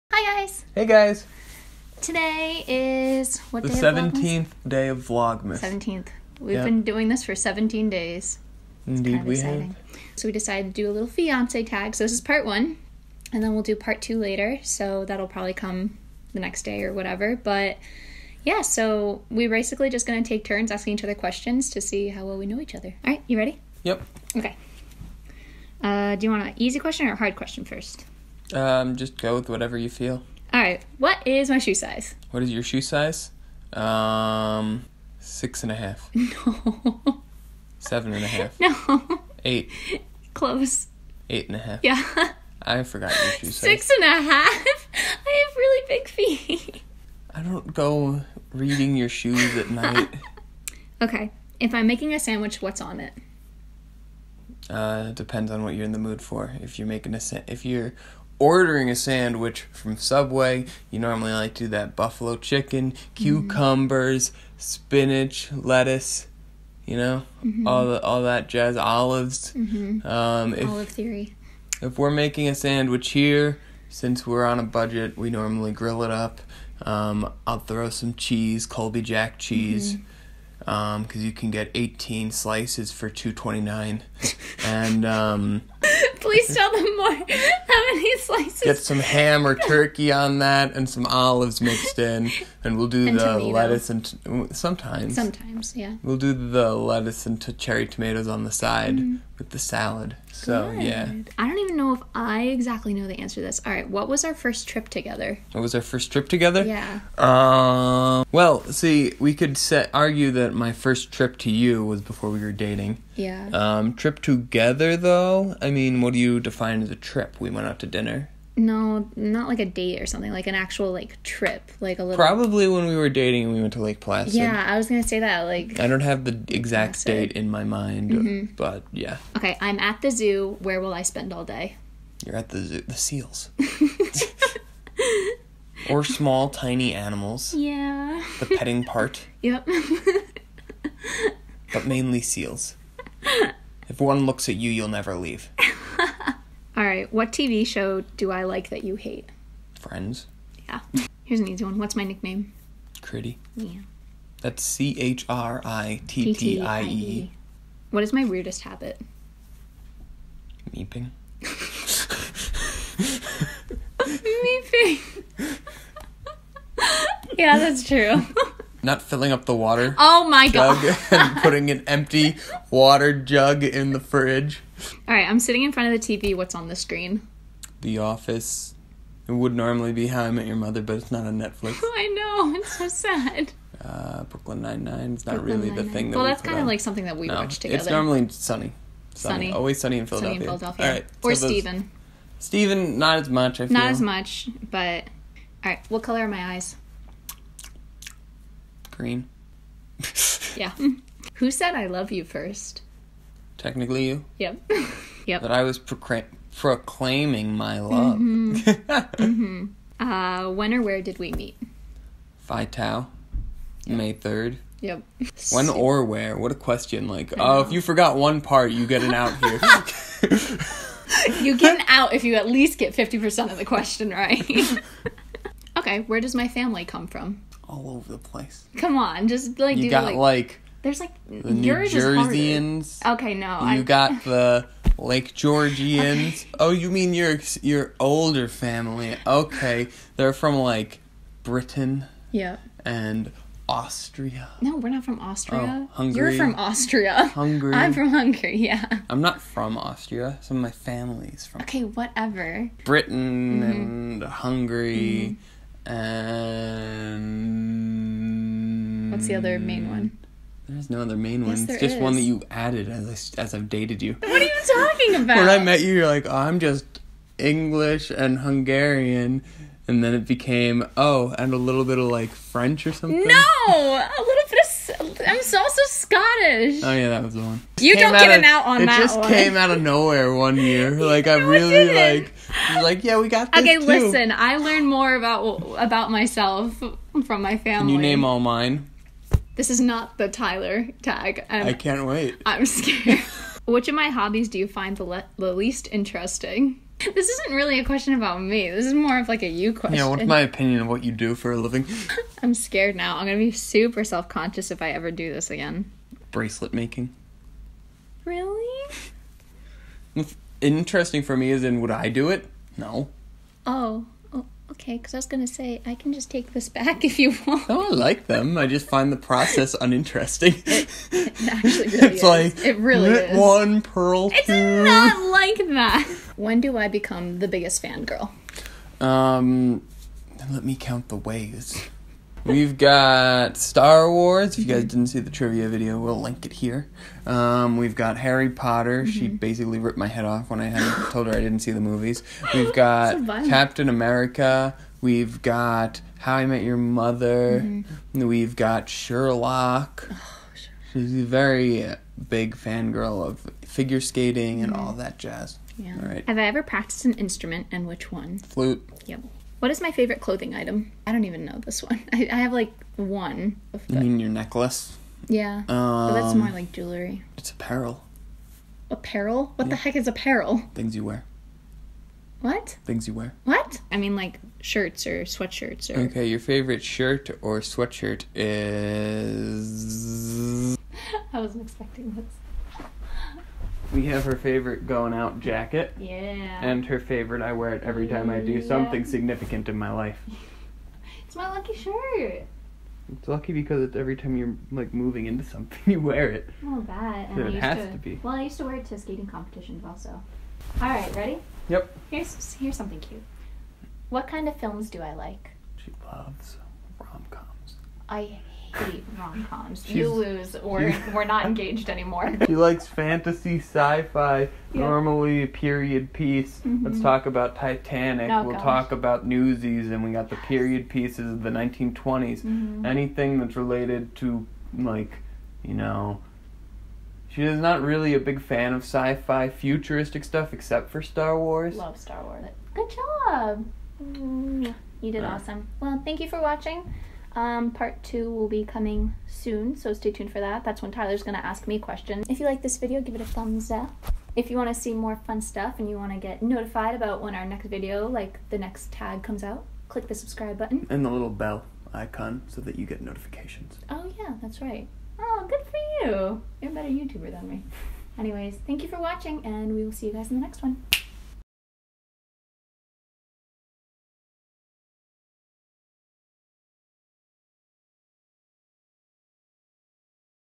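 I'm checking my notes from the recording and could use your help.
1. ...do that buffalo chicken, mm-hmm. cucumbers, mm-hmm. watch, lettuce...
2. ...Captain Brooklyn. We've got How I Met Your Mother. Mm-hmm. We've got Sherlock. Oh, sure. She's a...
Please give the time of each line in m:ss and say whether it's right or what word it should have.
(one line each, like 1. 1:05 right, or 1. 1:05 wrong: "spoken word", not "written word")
1. 1:01 wrong: "spinach", not "watch"
2. 5:43 wrong: "America", not "Brooklyn".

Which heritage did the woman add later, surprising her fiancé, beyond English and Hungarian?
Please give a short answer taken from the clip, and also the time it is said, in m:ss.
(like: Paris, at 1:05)
Scottish, at 4:35.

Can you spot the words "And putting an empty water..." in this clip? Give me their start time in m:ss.
2:51.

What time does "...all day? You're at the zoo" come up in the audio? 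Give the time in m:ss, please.
2:11.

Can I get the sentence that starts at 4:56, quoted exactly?
This isn't really a question about me.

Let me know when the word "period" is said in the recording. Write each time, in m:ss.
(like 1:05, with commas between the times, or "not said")
6:55, 7:00.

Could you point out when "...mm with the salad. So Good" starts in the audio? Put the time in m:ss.
1:38.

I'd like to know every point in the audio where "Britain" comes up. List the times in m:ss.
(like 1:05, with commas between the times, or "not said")
4:01, 4:12.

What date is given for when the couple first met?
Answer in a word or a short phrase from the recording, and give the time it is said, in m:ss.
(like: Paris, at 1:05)
May 3rd, at 3:33.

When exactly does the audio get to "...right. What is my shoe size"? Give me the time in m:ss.
0:30.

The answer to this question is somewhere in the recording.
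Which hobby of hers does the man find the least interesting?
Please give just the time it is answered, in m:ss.
5:06.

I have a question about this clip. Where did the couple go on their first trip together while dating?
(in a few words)
Lake Placid.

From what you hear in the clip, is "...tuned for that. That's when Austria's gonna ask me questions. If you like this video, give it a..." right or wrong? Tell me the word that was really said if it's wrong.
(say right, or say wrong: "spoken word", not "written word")
wrong: "Tyler", not "Austria".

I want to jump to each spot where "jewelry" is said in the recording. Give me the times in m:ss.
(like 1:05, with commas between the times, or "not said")
6:06.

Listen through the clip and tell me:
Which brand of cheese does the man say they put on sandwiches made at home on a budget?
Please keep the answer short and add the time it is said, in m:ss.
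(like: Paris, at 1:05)
Colby Jack, at 1:18.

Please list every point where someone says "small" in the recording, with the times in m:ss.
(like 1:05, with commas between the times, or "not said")
2:16.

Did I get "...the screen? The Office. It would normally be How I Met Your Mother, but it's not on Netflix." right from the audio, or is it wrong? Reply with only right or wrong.
right.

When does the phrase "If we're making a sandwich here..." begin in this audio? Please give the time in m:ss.
1:11.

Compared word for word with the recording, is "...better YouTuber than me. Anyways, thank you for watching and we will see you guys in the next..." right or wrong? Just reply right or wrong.
right.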